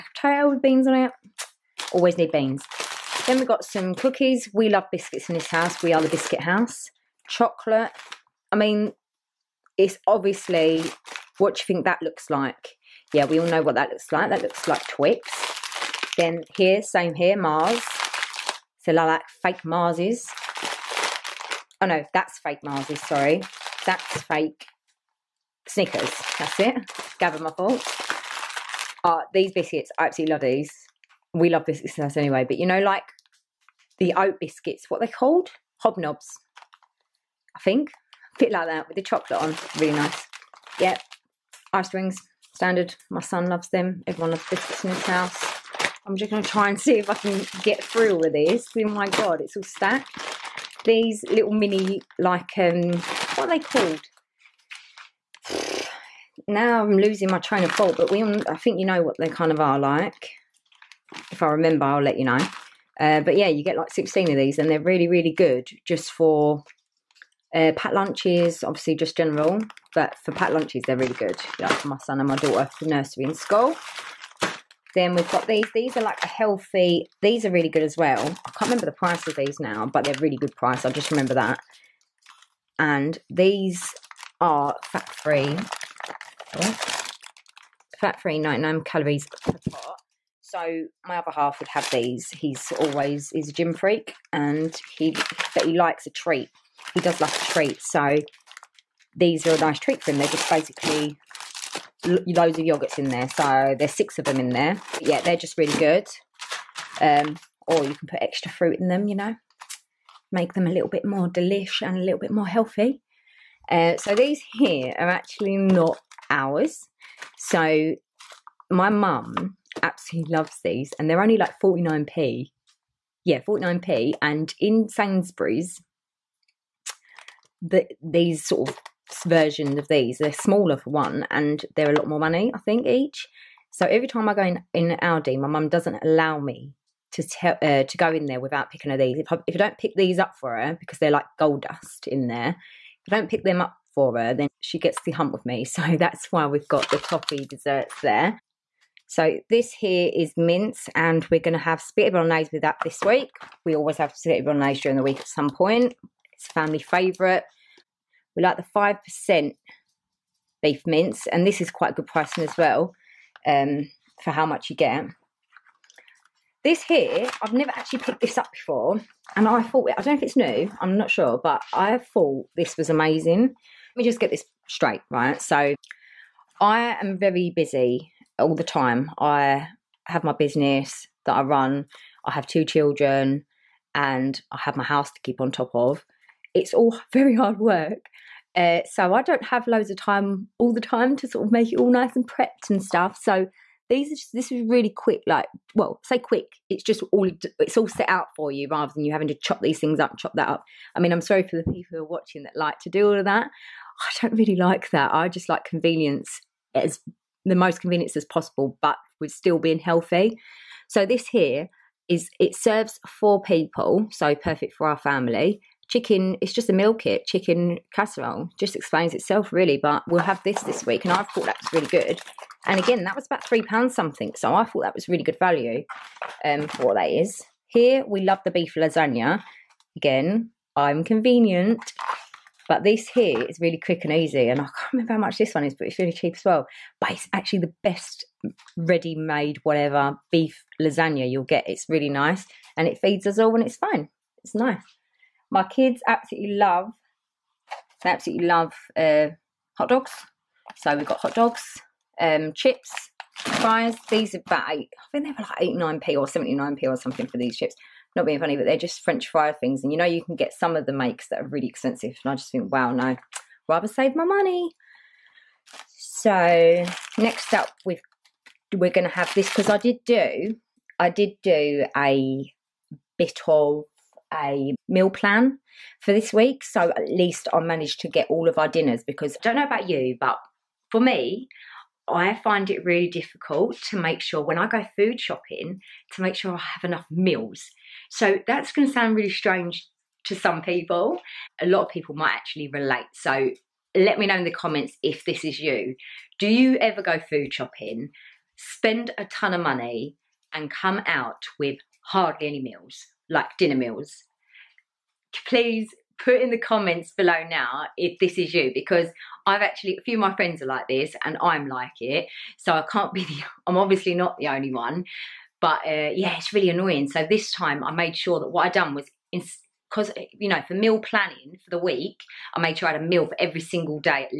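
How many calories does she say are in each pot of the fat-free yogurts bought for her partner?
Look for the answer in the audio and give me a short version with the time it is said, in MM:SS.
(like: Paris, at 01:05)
99, at 01:28.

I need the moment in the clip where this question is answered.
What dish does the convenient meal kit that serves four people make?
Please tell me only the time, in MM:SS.
03:37.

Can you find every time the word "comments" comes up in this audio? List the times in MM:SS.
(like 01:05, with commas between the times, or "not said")
04:54, 05:06.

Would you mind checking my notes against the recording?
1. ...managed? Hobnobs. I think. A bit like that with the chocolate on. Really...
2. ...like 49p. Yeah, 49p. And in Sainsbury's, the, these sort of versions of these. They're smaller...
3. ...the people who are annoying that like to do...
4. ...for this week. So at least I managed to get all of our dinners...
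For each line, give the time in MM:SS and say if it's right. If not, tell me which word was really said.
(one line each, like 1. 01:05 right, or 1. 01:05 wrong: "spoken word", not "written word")
1. 00:35 wrong: "called", not "managed"
2. 02:01 right
3. 03:21 wrong: "watching", not "annoying"
4. 04:36 right.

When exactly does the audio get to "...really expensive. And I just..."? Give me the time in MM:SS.
04:21.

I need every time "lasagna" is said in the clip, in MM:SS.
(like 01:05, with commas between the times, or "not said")
03:48, 04:00.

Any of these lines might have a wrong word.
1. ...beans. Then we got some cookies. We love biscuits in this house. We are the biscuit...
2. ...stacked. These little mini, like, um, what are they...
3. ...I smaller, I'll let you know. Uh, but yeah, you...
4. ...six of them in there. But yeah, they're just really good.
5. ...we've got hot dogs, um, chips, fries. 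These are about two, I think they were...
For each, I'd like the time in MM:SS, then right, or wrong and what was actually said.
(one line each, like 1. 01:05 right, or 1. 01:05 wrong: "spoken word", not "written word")
1. 00:02 right
2. 00:49 right
3. 01:01 wrong: "remember", not "smaller"
4. 01:43 right
5. 04:10 wrong: "eight", not "two".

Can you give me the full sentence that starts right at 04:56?
Do you ever go food shopping, spend a ton of money, and come out with hardly any meals?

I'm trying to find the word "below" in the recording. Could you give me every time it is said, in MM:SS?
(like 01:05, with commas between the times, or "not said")
05:07.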